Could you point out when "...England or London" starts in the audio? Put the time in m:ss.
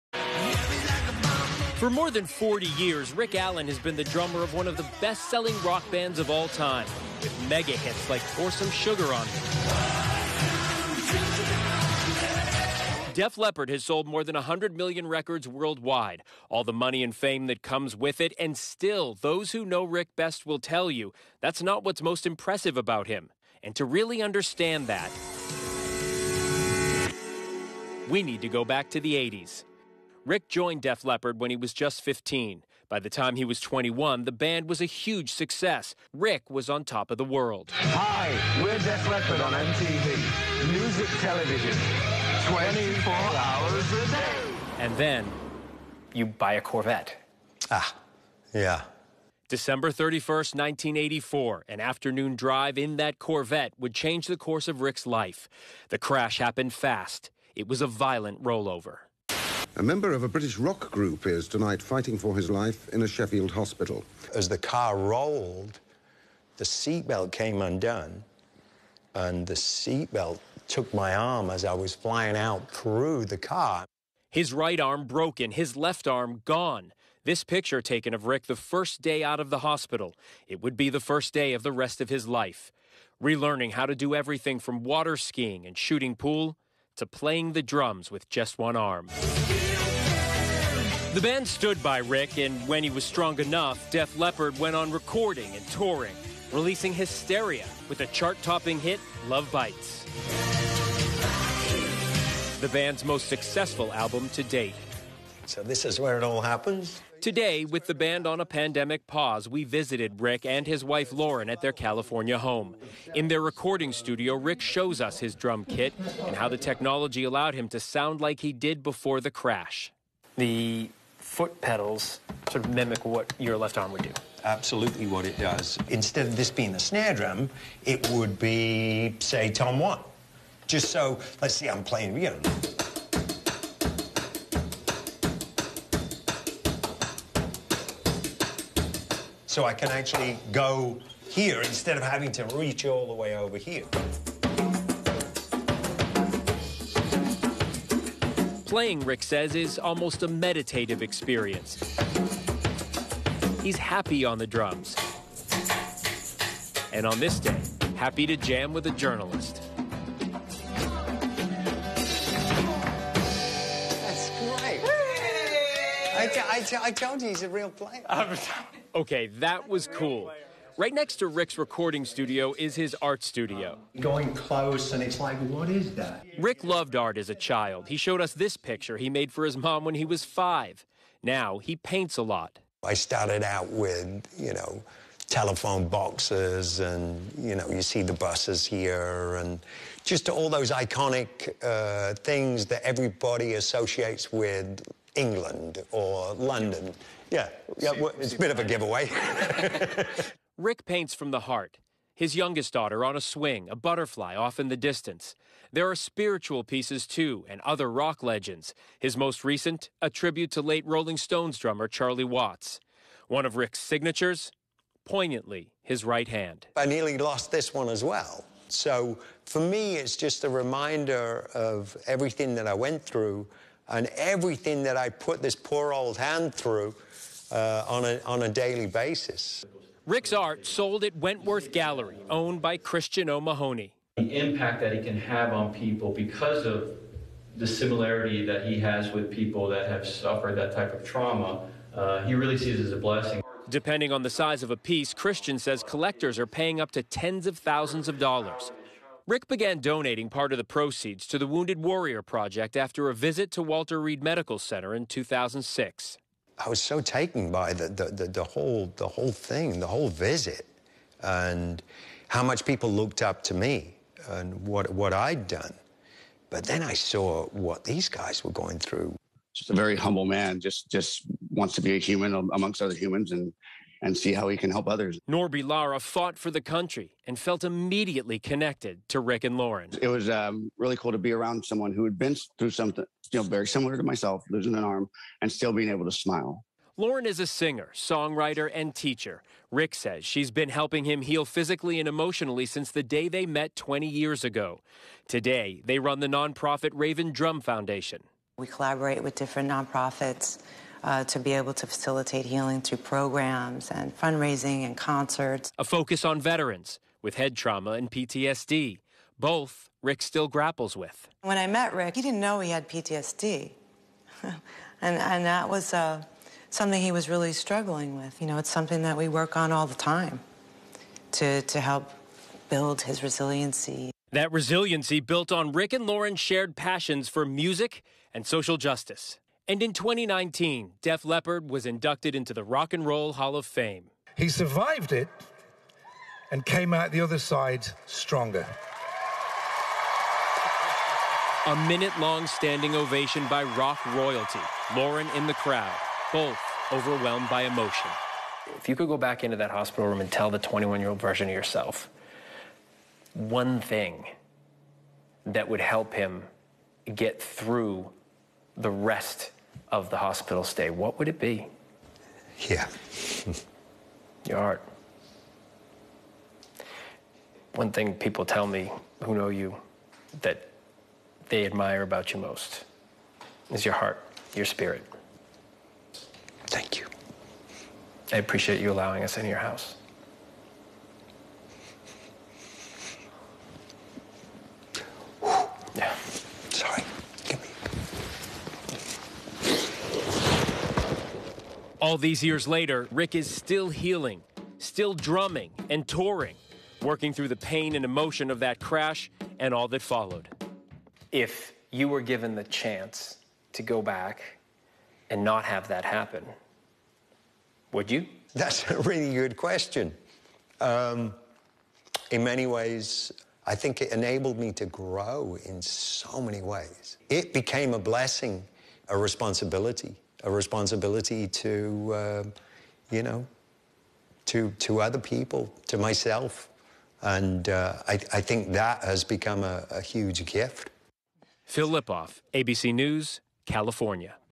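3:15.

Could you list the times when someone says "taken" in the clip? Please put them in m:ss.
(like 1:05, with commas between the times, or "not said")
1:17, 4:17.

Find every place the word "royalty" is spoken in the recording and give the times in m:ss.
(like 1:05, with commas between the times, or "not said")
5:44.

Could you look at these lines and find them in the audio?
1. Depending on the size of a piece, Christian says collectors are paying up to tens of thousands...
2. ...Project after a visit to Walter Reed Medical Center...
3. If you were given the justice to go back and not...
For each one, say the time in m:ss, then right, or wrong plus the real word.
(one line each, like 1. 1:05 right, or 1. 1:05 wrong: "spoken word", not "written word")
1. 4:03 right
2. 4:12 right
3. 6:41 wrong: "chance", not "justice".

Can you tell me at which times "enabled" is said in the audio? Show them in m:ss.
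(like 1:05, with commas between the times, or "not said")
6:54.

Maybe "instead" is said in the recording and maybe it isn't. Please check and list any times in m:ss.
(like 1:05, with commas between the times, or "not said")
2:05, 2:21.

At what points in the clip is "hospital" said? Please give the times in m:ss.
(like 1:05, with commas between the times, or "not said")
1:03, 1:19, 5:49, 6:00.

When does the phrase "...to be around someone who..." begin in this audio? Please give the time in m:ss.
4:41.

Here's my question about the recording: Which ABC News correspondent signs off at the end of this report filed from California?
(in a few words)
Phil Lipof.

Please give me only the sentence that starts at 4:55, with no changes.
Today, they run the nonprofit Raven Drum Foundation.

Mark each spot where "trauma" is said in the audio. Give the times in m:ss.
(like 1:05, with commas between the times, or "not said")
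4:01, 5:07.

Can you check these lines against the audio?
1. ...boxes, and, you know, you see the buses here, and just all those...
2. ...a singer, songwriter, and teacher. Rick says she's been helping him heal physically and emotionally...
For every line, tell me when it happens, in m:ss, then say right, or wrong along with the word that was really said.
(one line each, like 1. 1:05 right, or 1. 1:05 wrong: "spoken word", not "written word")
1. 3:05 right
2. 4:47 right.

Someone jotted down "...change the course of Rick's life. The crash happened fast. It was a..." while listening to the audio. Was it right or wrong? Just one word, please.
right.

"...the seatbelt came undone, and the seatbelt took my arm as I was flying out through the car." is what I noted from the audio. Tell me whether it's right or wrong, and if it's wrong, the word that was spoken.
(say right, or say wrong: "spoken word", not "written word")
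right.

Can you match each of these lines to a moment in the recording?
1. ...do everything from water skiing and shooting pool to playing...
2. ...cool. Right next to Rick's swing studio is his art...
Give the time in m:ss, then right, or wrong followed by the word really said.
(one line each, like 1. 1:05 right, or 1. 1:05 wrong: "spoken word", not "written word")
1. 1:23 right
2. 2:49 wrong: "recording", not "swing".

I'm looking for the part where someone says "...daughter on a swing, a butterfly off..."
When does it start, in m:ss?
3:22.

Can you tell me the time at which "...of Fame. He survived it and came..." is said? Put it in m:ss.
5:33.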